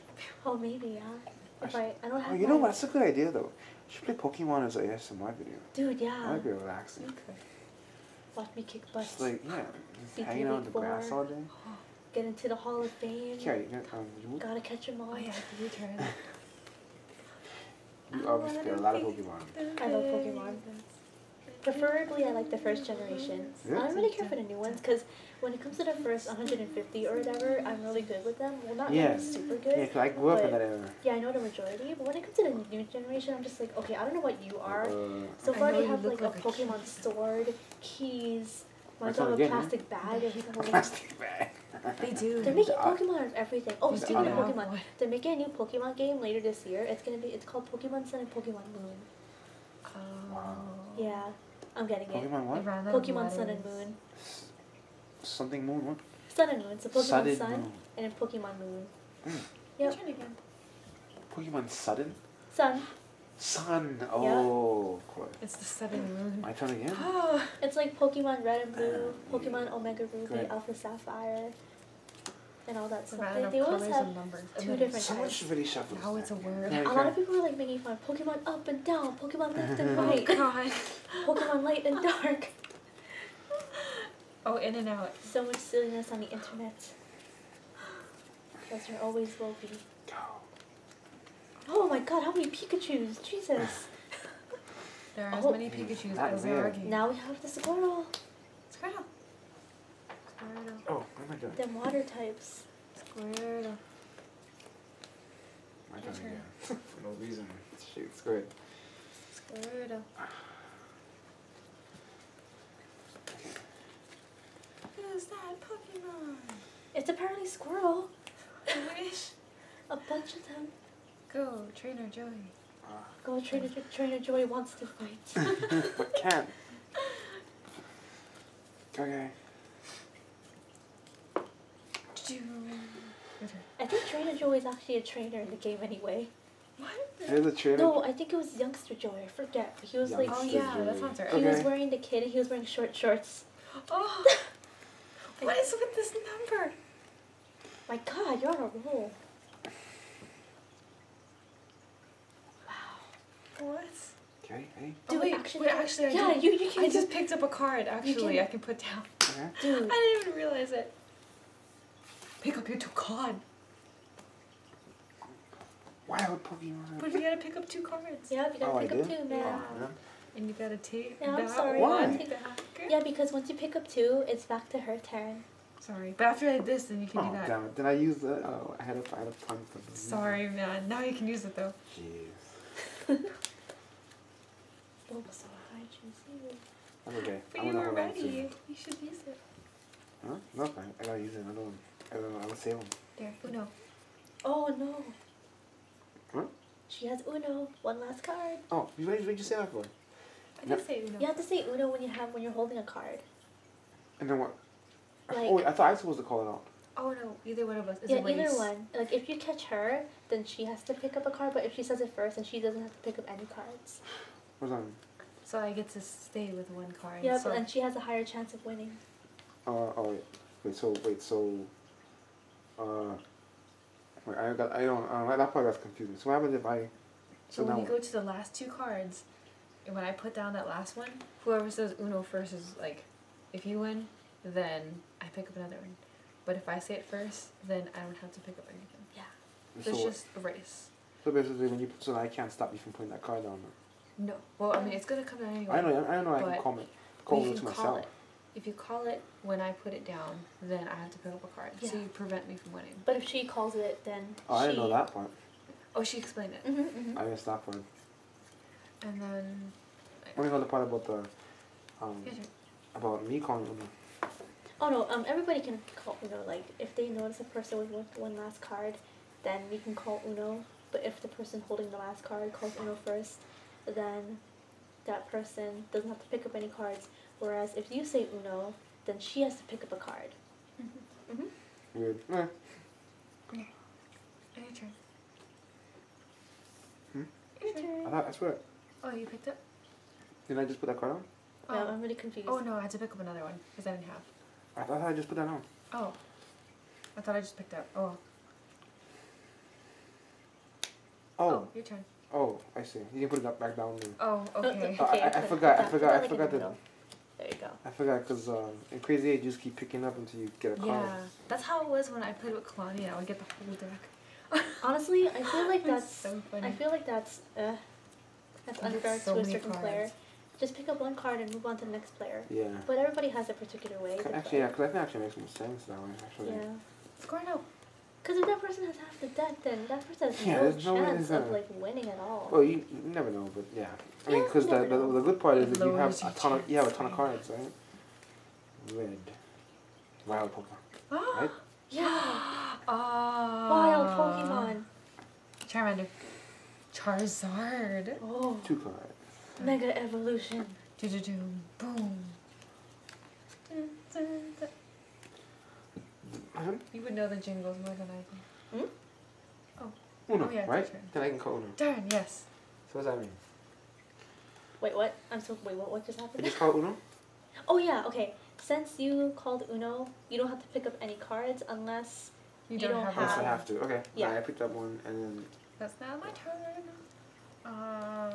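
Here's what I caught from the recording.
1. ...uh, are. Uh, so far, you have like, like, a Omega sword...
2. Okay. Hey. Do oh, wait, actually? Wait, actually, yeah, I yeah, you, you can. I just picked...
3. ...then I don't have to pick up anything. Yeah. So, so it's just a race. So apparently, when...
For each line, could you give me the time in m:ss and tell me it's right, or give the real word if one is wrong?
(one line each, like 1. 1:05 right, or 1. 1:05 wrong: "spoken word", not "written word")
1. 0:34 wrong: "Pokemon", not "Omega"
2. 2:34 right
3. 3:57 wrong: "basically", not "apparently".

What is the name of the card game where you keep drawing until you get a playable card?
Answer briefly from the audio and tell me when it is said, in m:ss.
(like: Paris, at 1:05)
Crazy Eight, at 5:08.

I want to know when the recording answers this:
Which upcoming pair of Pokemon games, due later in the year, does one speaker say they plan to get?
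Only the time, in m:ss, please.
0:47.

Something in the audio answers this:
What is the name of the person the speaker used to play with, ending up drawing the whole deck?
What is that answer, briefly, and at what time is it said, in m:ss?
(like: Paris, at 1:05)
Claudia, at 5:12.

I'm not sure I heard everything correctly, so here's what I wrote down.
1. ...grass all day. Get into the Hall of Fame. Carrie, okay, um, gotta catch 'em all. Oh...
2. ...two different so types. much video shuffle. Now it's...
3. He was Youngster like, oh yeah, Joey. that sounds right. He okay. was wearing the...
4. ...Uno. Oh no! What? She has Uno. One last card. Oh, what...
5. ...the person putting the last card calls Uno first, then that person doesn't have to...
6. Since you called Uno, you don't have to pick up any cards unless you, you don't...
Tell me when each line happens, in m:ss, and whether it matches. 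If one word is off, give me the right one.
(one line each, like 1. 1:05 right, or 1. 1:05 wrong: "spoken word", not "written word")
1. 0:10 right
2. 1:14 right
3. 2:19 right
4. 3:13 right
5. 4:31 wrong: "holding", not "putting"
6. 6:08 right.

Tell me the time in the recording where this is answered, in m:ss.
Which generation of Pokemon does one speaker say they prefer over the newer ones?
0:22.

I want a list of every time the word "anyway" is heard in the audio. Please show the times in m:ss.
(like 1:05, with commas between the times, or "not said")
2:15, 4:05.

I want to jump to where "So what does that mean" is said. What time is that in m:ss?
6:02.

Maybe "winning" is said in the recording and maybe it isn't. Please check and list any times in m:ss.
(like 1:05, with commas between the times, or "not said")
3:38, 4:12, 5:31.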